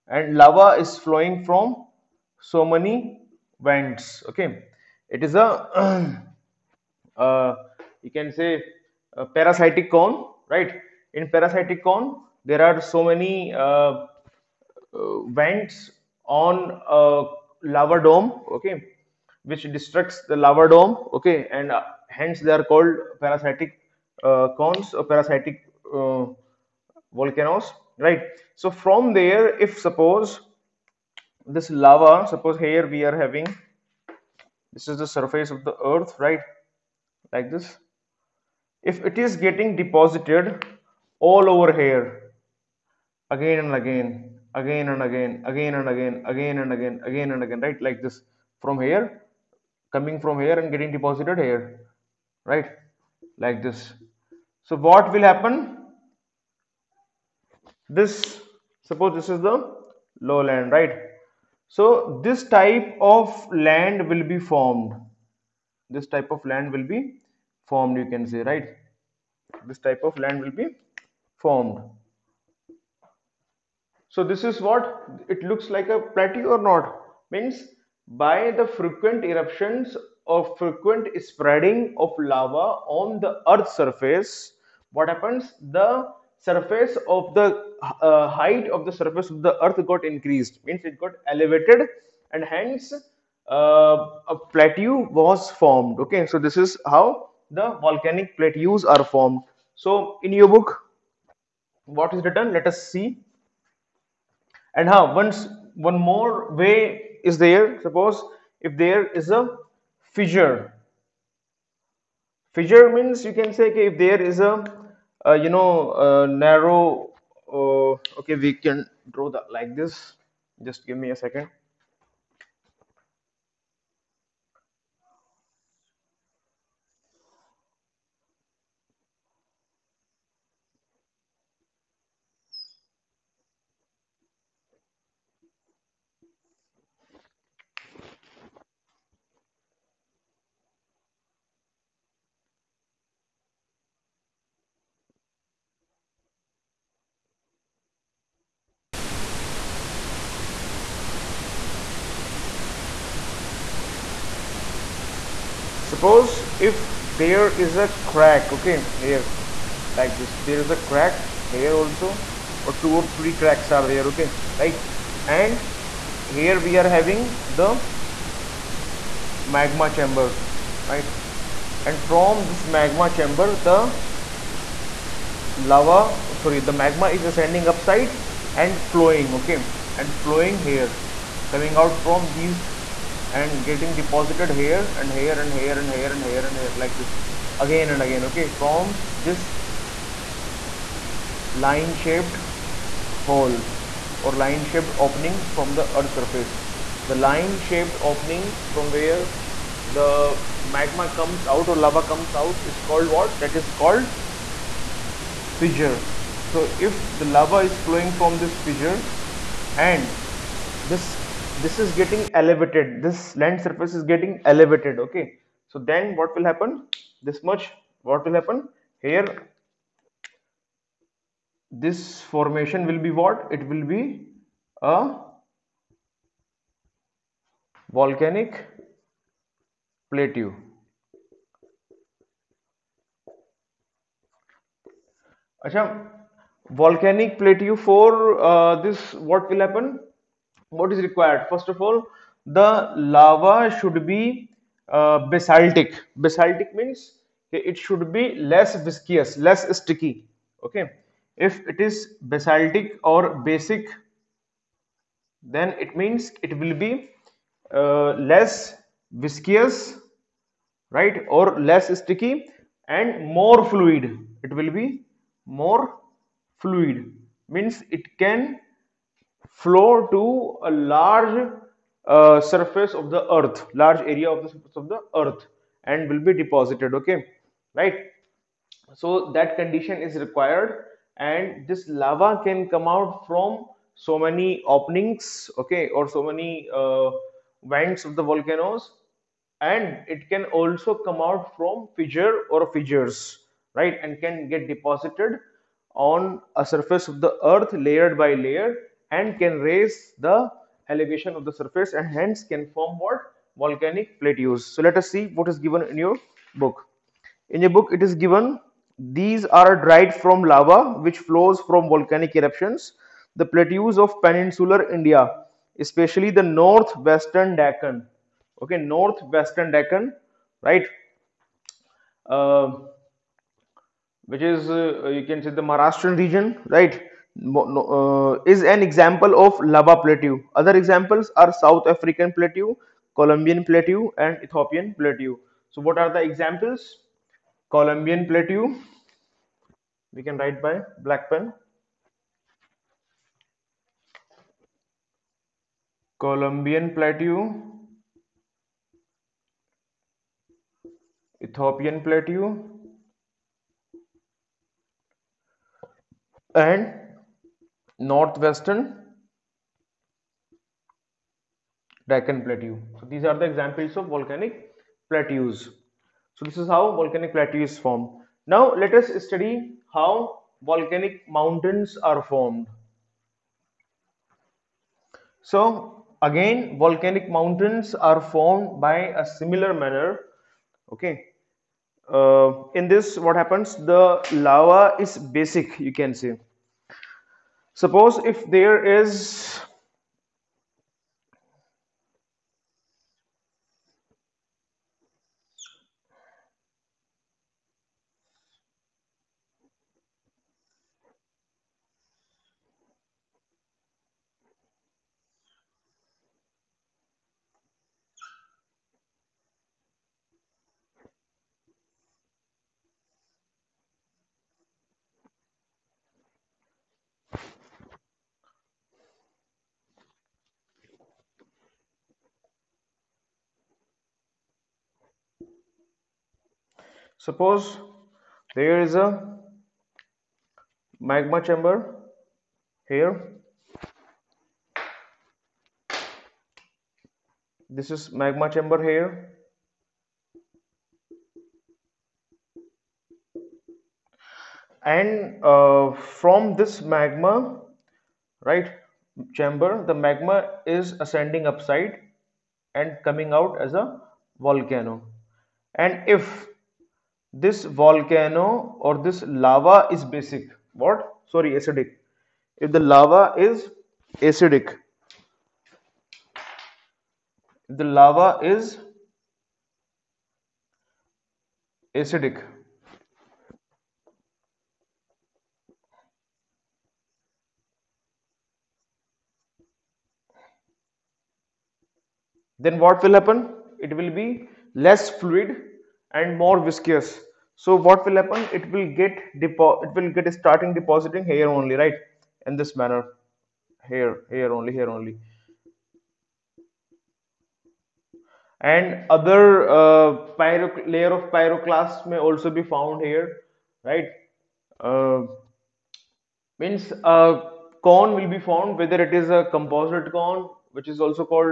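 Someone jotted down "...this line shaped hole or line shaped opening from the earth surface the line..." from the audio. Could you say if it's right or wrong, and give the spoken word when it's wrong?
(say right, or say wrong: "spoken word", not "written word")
right.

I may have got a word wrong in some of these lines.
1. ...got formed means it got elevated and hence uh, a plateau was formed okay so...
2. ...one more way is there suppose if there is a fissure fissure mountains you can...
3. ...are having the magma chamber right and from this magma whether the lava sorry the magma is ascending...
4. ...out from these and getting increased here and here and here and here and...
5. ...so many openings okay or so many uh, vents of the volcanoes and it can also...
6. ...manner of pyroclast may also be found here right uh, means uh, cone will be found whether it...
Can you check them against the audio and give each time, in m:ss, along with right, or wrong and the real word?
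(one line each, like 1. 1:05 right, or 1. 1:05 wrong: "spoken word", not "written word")
1. 1:29 wrong: "increased", not "formed"
2. 1:45 wrong: "means", not "mountains"
3. 2:46 wrong: "chamber", not "whether"
4. 3:01 wrong: "deposited", not "increased"
5. 4:44 right
6. 8:20 wrong: "layer", not "manner".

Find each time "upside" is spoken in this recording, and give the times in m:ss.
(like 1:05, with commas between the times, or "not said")
2:57, 7:31.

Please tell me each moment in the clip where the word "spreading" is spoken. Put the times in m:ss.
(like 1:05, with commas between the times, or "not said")
1:21.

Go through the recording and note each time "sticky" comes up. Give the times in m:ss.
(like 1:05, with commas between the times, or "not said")
4:09, 4:21.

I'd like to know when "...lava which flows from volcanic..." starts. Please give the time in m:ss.
5:10.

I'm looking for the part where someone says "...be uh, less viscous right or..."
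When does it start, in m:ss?
4:16.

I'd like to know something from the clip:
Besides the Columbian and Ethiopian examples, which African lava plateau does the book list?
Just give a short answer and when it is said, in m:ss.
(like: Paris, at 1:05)
South African plateau, at 5:31.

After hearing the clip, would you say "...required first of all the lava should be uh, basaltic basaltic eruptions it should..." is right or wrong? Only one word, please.
wrong.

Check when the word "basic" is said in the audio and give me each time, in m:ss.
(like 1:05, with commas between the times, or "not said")
4:13, 6:25, 7:40.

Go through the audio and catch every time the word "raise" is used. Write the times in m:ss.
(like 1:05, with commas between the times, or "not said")
4:59.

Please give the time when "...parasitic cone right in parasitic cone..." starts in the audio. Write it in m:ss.
0:09.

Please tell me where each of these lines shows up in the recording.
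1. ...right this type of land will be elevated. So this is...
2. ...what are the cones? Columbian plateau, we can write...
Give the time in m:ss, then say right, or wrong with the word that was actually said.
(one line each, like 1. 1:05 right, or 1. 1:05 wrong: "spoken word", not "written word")
1. 1:08 wrong: "formed", not "elevated"
2. 5:35 wrong: "examples", not "cones".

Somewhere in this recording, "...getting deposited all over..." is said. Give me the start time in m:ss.
0:39.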